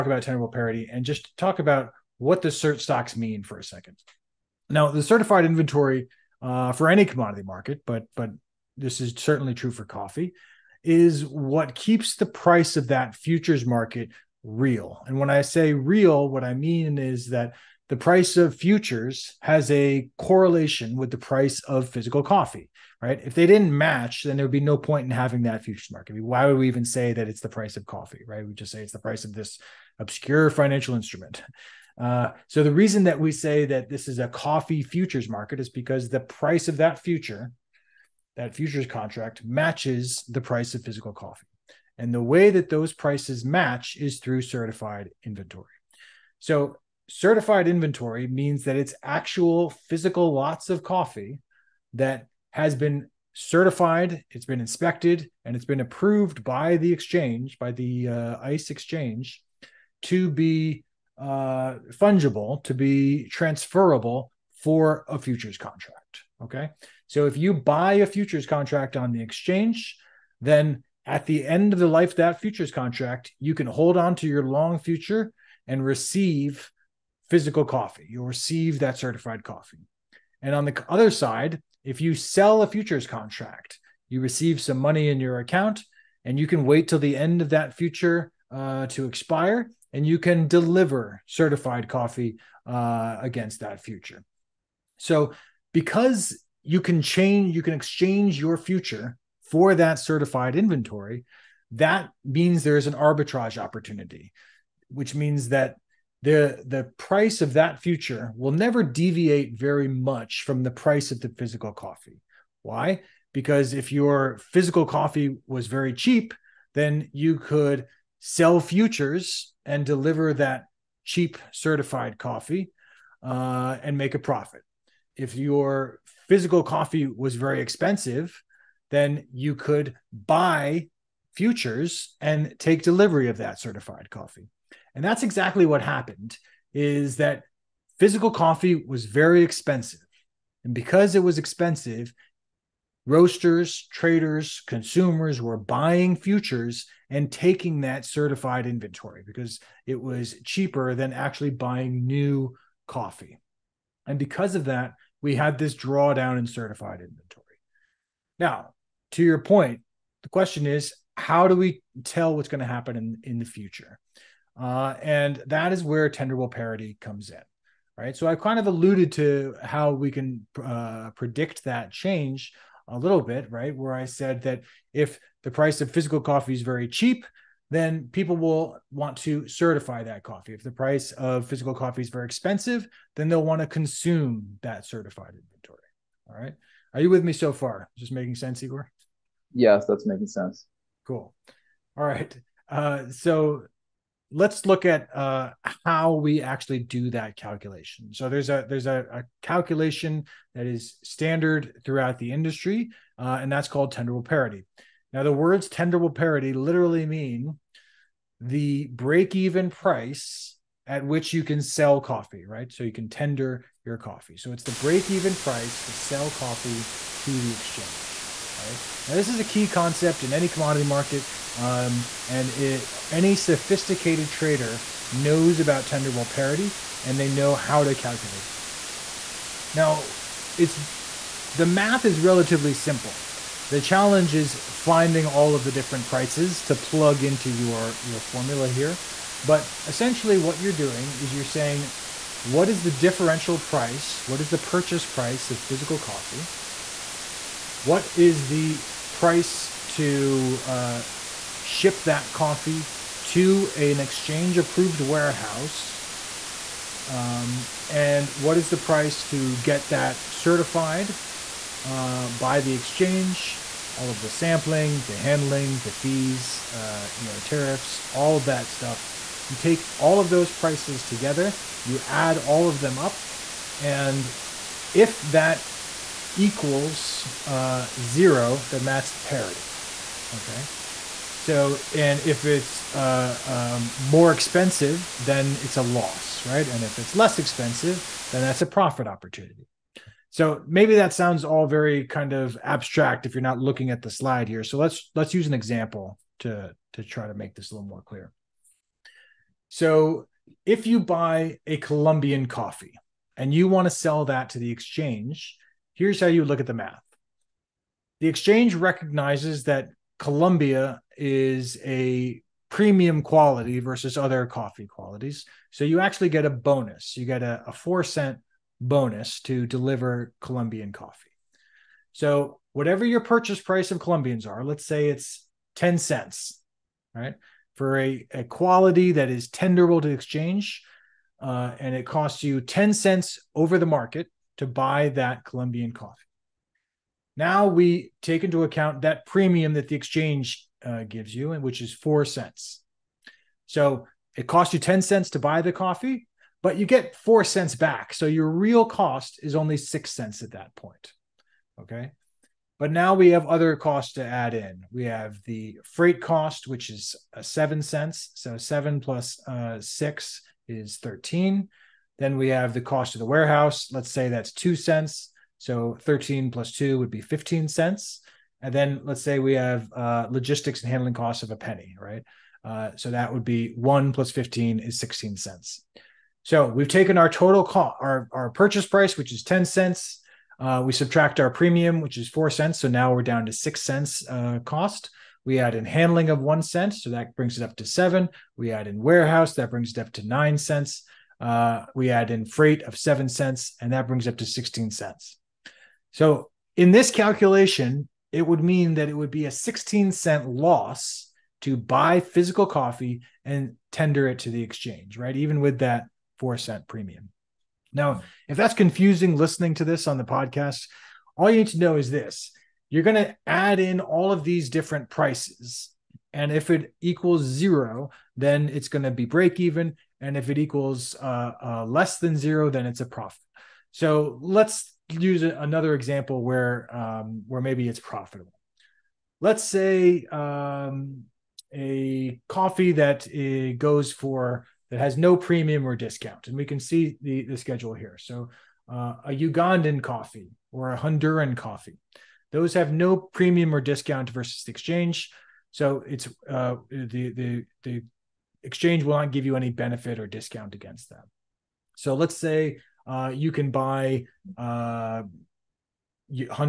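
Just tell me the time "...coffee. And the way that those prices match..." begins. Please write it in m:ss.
0:41.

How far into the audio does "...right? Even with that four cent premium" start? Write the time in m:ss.
6:45.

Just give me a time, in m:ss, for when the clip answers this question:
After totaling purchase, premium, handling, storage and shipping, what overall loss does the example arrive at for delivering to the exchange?
6:39.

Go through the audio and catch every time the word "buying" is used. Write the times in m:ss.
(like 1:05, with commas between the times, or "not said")
2:25, 2:31.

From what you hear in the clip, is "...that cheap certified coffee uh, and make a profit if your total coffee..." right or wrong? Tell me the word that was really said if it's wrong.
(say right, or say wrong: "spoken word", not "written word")
wrong: "physical", not "total".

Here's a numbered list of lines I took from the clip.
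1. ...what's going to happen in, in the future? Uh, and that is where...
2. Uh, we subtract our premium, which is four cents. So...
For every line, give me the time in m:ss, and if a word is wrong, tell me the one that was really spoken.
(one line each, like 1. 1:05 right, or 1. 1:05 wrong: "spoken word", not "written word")
1. 2:42 right
2. 6:20 right.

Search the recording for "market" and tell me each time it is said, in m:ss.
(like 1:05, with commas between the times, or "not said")
0:07, 0:13, 0:25, 0:35, 3:40, 5:33.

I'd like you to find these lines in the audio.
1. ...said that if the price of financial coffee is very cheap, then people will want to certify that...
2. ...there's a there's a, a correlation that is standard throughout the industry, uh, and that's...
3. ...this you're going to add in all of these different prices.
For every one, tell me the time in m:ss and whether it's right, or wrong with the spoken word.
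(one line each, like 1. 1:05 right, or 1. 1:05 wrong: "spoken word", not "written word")
1. 2:54 wrong: "physical", not "financial"
2. 3:18 wrong: "calculation", not "correlation"
3. 6:52 right.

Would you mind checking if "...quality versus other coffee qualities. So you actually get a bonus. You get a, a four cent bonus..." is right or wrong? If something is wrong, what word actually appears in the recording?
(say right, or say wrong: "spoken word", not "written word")
right.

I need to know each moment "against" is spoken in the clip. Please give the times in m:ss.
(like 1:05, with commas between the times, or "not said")
1:33, 7:30.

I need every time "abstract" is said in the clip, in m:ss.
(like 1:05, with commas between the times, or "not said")
4:52.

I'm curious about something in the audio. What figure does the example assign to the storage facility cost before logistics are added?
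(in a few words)
2 cents.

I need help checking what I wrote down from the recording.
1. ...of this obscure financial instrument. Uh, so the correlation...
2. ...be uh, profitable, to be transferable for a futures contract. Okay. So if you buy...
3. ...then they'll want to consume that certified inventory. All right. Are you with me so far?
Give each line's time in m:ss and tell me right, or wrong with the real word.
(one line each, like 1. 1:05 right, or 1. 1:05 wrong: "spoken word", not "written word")
1. 0:29 wrong: "reason", not "correlation"
2. 1:00 wrong: "fungible", not "profitable"
3. 3:03 right.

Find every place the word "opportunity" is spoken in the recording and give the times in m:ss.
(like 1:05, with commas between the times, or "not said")
1:43, 4:49.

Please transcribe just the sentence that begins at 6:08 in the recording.
And then let's say we have uh, logistics and handling costs of a penny, right?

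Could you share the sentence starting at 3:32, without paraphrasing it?
So you can tender your coffee.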